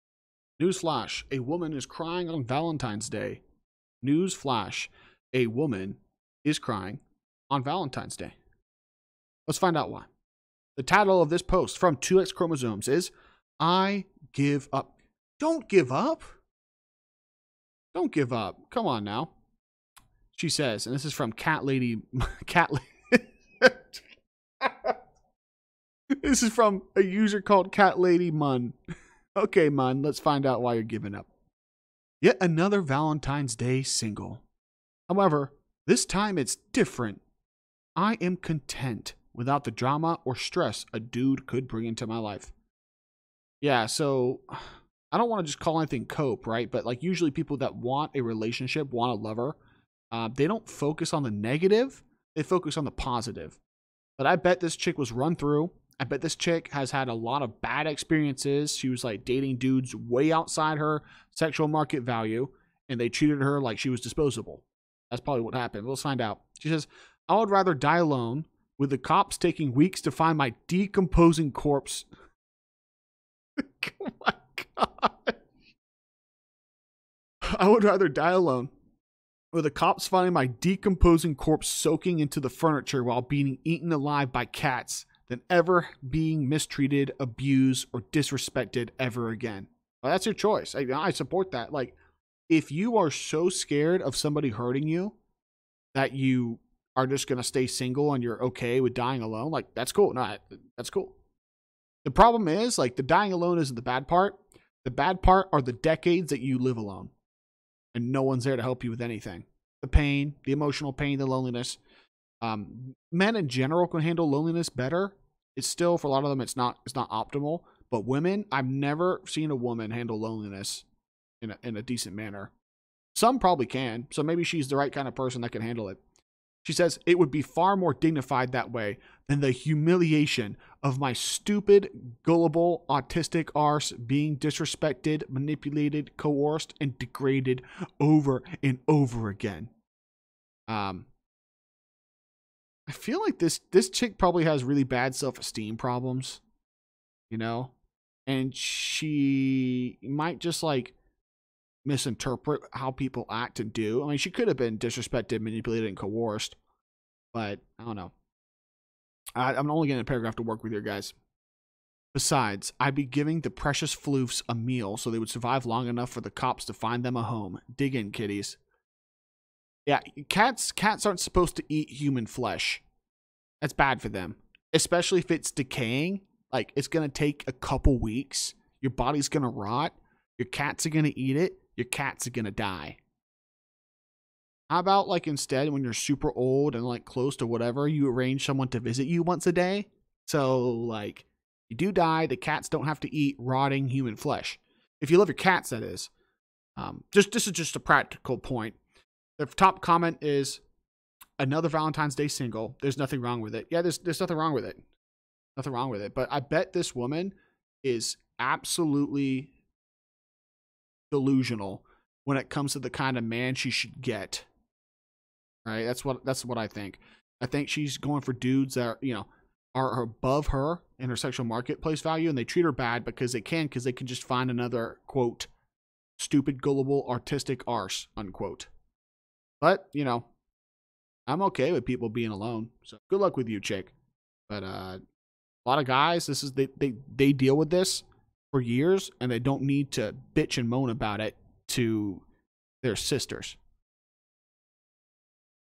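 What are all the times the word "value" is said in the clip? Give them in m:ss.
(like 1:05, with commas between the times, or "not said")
1:02, 3:42.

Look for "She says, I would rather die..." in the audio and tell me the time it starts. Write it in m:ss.
1:06.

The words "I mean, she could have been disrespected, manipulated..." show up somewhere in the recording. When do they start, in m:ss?
2:34.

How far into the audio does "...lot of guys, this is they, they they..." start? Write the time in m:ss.
3:55.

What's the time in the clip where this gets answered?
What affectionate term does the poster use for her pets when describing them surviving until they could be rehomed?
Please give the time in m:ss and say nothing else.
2:43.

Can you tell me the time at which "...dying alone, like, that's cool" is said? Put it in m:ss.
1:38.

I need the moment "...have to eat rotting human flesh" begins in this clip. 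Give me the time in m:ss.
3:12.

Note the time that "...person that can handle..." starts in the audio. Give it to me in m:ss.
2:05.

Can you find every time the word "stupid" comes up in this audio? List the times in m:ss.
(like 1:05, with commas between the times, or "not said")
2:11, 3:46.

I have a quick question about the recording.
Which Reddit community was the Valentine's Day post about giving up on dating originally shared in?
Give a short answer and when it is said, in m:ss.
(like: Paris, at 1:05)
2X Chromosomes, at 0:11.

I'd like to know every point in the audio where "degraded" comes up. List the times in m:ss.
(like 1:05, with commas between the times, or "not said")
2:16.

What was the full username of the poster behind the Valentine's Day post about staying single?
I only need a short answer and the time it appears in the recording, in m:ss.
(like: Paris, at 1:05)
Cat Lady Mun, at 0:27.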